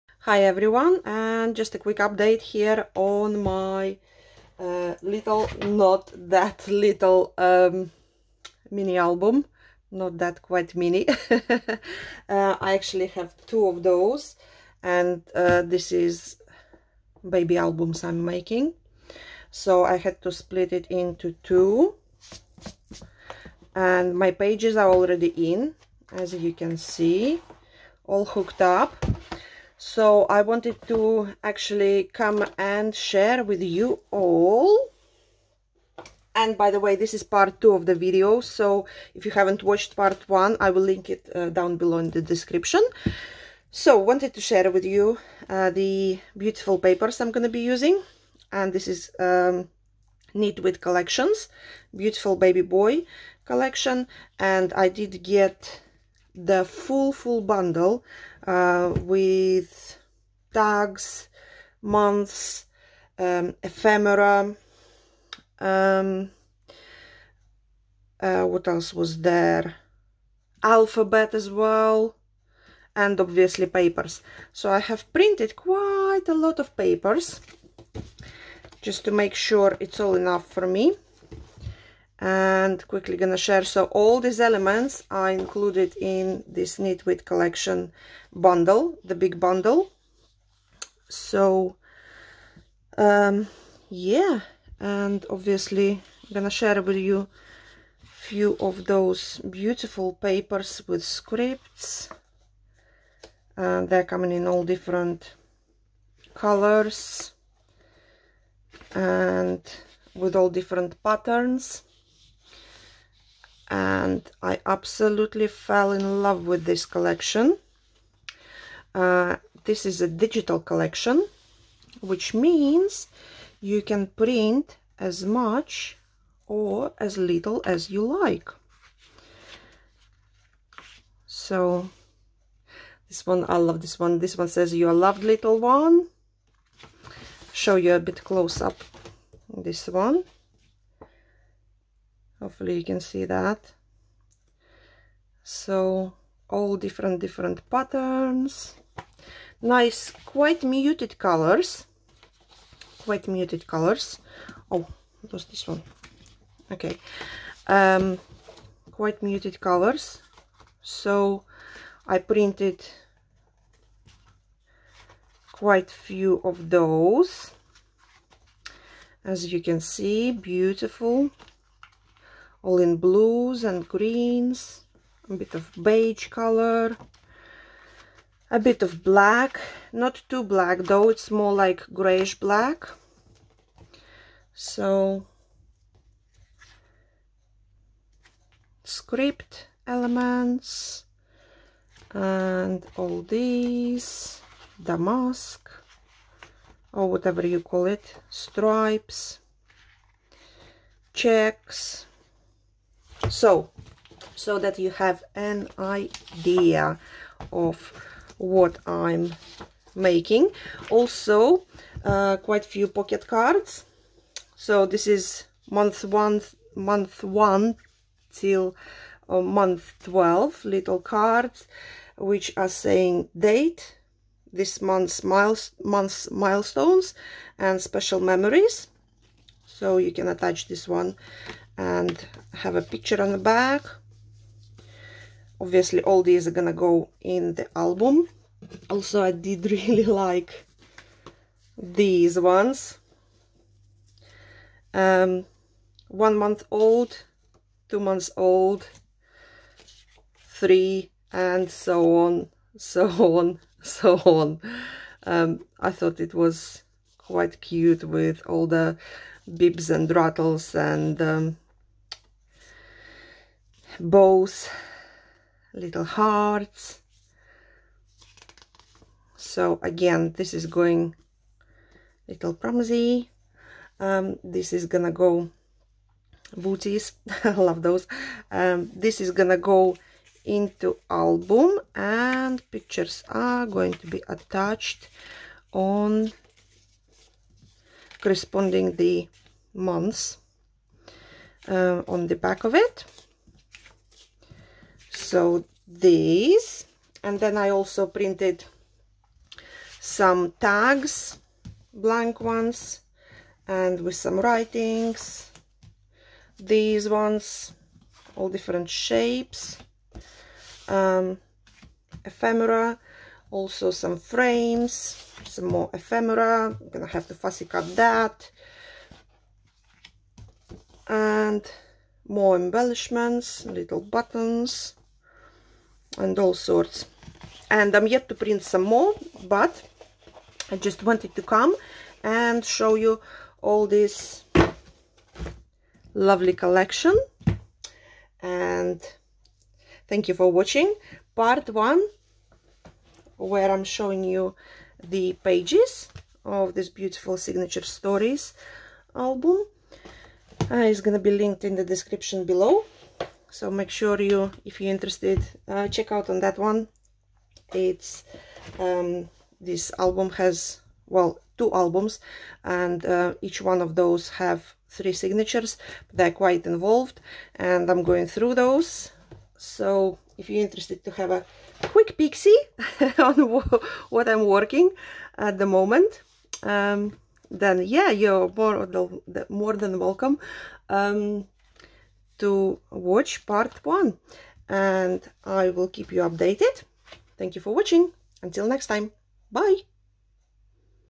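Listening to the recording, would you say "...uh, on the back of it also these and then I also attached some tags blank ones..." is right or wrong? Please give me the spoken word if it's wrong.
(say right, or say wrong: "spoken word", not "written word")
wrong: "printed", not "attached".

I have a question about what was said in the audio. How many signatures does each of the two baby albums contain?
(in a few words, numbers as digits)
3.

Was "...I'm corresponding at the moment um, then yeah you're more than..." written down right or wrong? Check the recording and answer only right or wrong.
wrong.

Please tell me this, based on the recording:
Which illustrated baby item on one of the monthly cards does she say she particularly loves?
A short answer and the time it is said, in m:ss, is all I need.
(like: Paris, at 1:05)
Booties, at 4:36.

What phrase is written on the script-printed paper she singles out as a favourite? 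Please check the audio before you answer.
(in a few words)
You are loved little one.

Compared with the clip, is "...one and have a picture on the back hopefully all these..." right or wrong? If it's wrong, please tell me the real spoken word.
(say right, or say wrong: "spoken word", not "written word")
wrong: "obviously", not "hopefully".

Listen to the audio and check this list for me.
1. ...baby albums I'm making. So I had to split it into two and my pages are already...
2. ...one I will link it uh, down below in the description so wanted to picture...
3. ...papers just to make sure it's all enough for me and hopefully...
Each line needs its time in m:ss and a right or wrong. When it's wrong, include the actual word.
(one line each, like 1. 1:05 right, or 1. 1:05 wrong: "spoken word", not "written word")
1. 0:17 right
2. 0:40 wrong: "share", not "picture"
3. 1:16 wrong: "quickly", not "hopefully".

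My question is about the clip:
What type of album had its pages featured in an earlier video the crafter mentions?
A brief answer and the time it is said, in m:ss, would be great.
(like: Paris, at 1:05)
Signature stories, at 5:47.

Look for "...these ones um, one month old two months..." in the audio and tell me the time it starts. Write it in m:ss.
4:01.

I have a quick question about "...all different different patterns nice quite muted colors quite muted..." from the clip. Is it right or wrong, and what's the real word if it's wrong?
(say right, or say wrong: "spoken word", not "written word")
right.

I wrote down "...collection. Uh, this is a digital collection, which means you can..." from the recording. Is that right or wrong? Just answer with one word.
right.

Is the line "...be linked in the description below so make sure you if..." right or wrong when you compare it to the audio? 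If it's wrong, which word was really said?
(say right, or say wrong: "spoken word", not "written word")
right.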